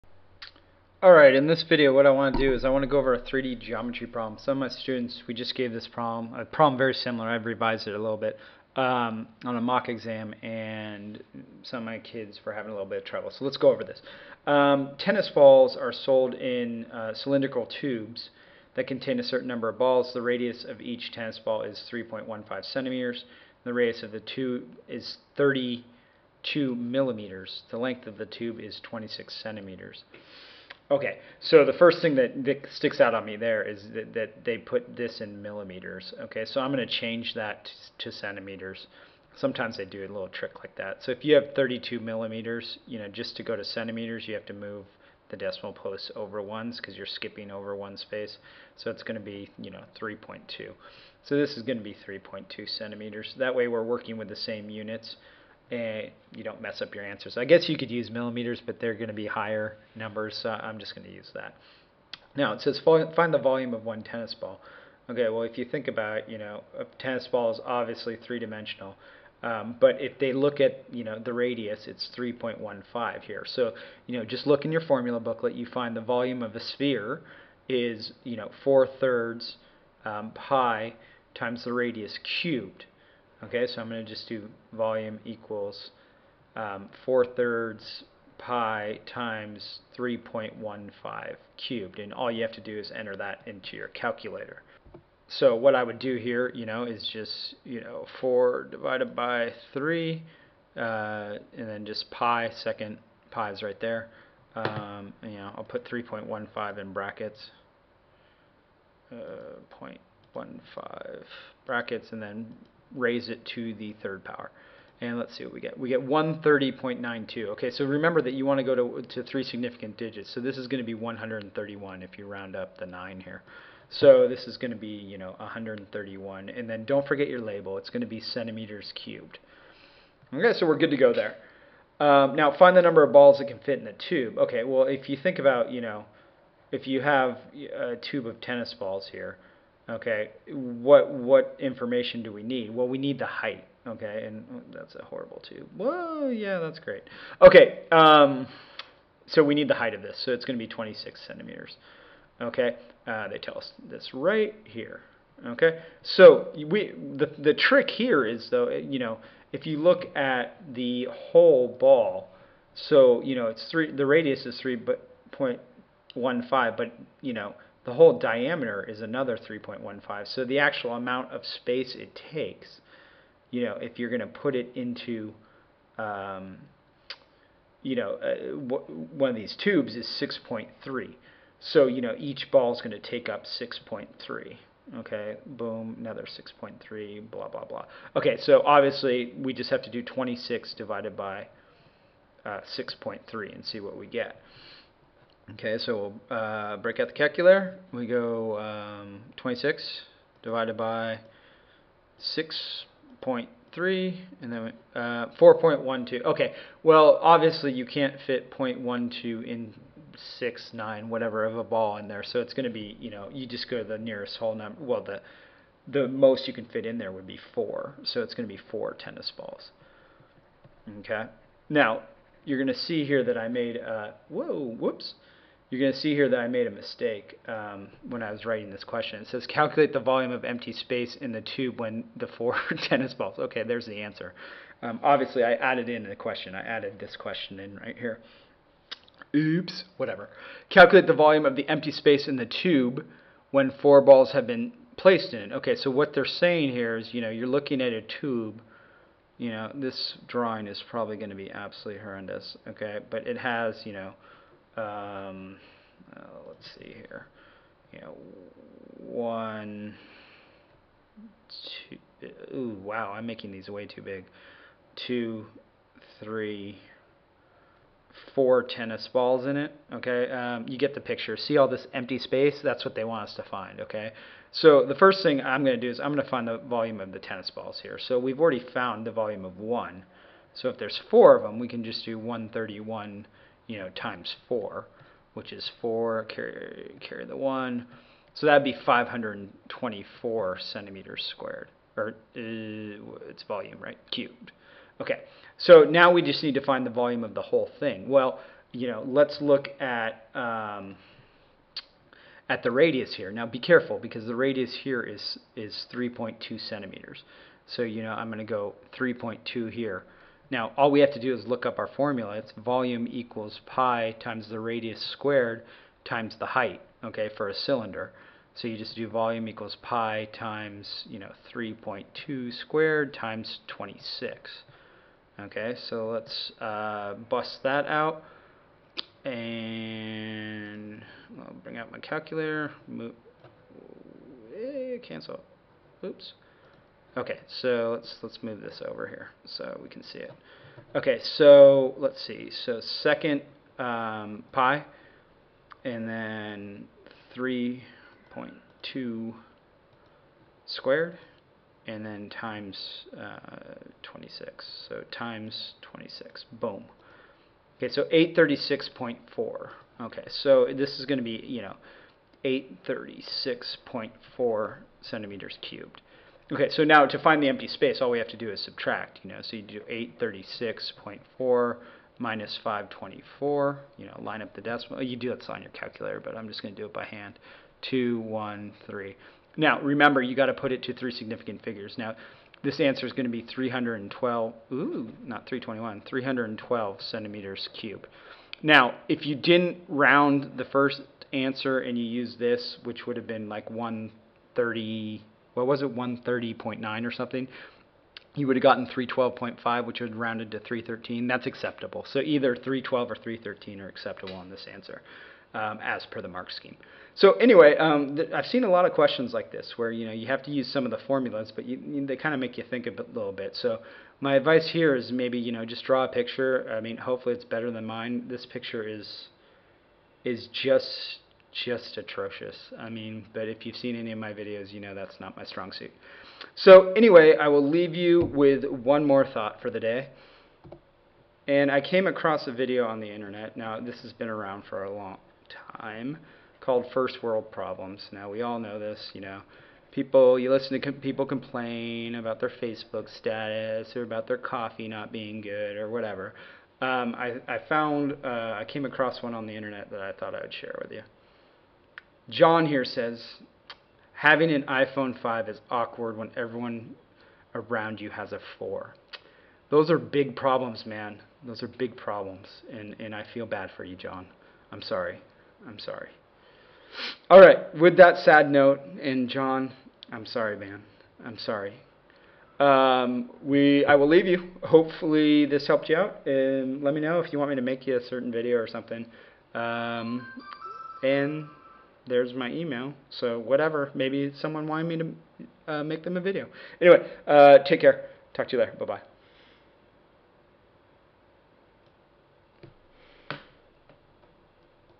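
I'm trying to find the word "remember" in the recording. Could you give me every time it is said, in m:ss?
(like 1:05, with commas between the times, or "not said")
1:57, 6:19.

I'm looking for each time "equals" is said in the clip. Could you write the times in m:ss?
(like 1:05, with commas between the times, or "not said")
1:25, 5:13, 5:19.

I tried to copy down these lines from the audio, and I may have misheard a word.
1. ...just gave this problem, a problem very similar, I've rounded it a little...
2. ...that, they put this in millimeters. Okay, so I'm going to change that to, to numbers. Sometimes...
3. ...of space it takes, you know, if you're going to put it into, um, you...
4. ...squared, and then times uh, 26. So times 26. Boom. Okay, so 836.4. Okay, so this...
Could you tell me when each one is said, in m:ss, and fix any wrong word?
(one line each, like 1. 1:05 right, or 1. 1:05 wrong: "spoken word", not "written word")
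1. 0:05 wrong: "revised", not "rounded"
2. 0:34 wrong: "centimeters", not "numbers"
3. 2:51 right
4. 5:50 right.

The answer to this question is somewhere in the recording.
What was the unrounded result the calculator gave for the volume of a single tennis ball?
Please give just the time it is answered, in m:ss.
1:56.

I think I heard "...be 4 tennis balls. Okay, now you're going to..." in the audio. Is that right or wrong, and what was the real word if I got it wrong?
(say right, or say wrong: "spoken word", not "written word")
right.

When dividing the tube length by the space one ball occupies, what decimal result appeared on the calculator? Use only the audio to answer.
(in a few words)
4.12.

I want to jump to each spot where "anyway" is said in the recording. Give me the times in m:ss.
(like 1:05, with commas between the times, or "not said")
6:47, 7:06, 8:06.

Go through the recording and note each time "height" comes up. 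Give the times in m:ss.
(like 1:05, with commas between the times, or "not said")
2:23, 2:29, 5:16.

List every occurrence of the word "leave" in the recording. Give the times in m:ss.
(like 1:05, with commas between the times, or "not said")
7:07, 7:54.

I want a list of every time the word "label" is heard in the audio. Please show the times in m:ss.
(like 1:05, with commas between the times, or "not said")
2:07.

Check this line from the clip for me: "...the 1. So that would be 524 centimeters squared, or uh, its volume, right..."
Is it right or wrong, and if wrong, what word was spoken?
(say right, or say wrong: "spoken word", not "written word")
right.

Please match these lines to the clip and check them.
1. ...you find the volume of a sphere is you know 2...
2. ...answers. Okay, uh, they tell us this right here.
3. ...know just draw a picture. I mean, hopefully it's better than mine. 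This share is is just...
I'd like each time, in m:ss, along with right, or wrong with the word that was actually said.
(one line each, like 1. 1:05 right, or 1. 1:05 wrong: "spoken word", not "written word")
1. 1:15 wrong: "4", not "2"
2. 2:31 wrong: "centimeters", not "answers"
3. 6:55 wrong: "picture", not "share".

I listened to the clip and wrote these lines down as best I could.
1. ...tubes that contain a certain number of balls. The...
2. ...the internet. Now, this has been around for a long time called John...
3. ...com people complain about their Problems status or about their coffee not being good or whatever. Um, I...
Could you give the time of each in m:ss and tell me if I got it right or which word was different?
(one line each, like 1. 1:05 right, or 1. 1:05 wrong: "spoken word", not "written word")
1. 0:17 right
2. 7:12 wrong: "First", not "John"
3. 7:20 wrong: "Facebook", not "Problems".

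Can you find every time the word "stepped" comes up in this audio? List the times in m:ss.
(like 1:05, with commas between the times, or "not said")
not said.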